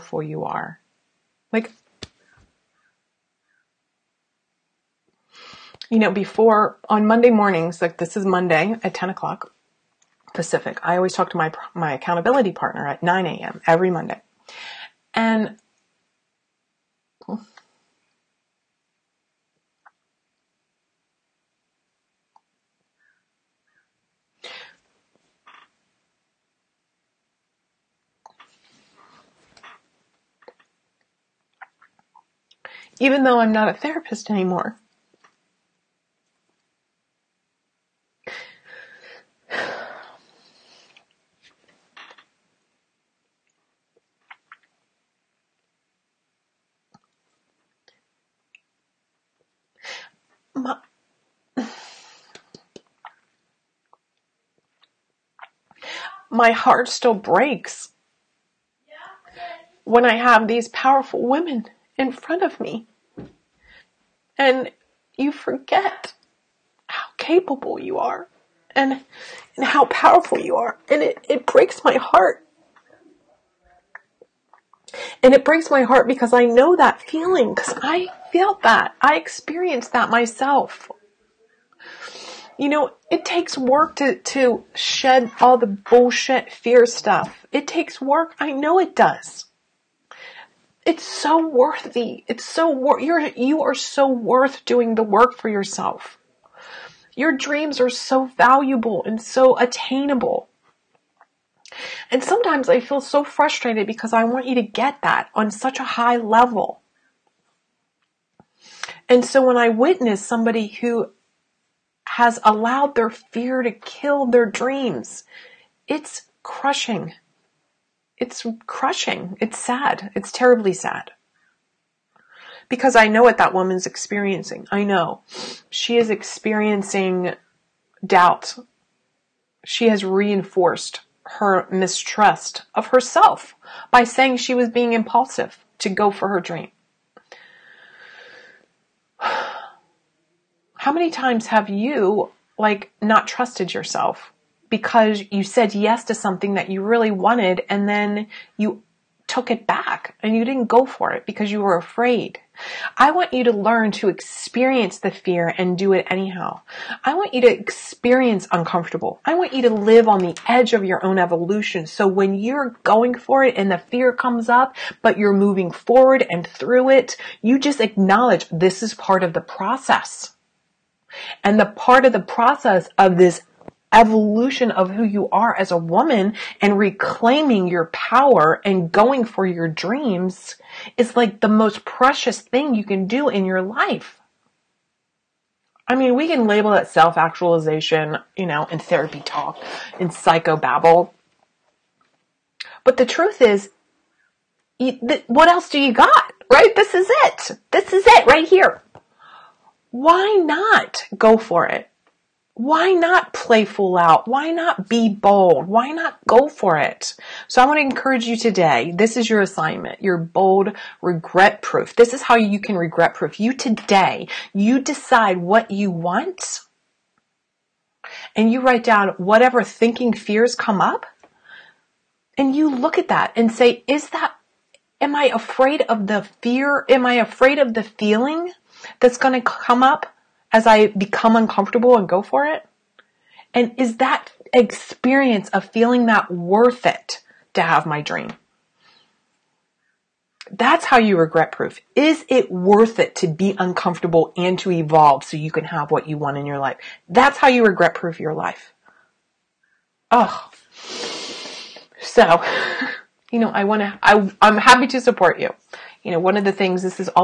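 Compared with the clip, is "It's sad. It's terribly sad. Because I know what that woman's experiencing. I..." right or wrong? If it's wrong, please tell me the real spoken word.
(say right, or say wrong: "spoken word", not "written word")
right.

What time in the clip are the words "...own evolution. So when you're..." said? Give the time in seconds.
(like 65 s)
161 s.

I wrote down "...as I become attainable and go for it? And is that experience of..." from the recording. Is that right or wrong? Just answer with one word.
wrong.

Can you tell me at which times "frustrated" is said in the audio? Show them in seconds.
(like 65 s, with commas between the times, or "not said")
103 s.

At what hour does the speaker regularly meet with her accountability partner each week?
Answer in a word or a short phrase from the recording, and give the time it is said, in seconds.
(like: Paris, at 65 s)
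9 a.m., at 13 s.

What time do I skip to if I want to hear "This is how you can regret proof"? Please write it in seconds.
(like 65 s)
211 s.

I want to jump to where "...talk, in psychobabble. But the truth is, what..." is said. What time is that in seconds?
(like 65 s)
189 s.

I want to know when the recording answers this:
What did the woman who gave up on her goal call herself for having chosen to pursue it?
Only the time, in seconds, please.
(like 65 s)
134 s.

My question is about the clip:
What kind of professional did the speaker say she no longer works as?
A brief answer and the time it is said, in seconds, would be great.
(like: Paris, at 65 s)
therapist, at 33 s.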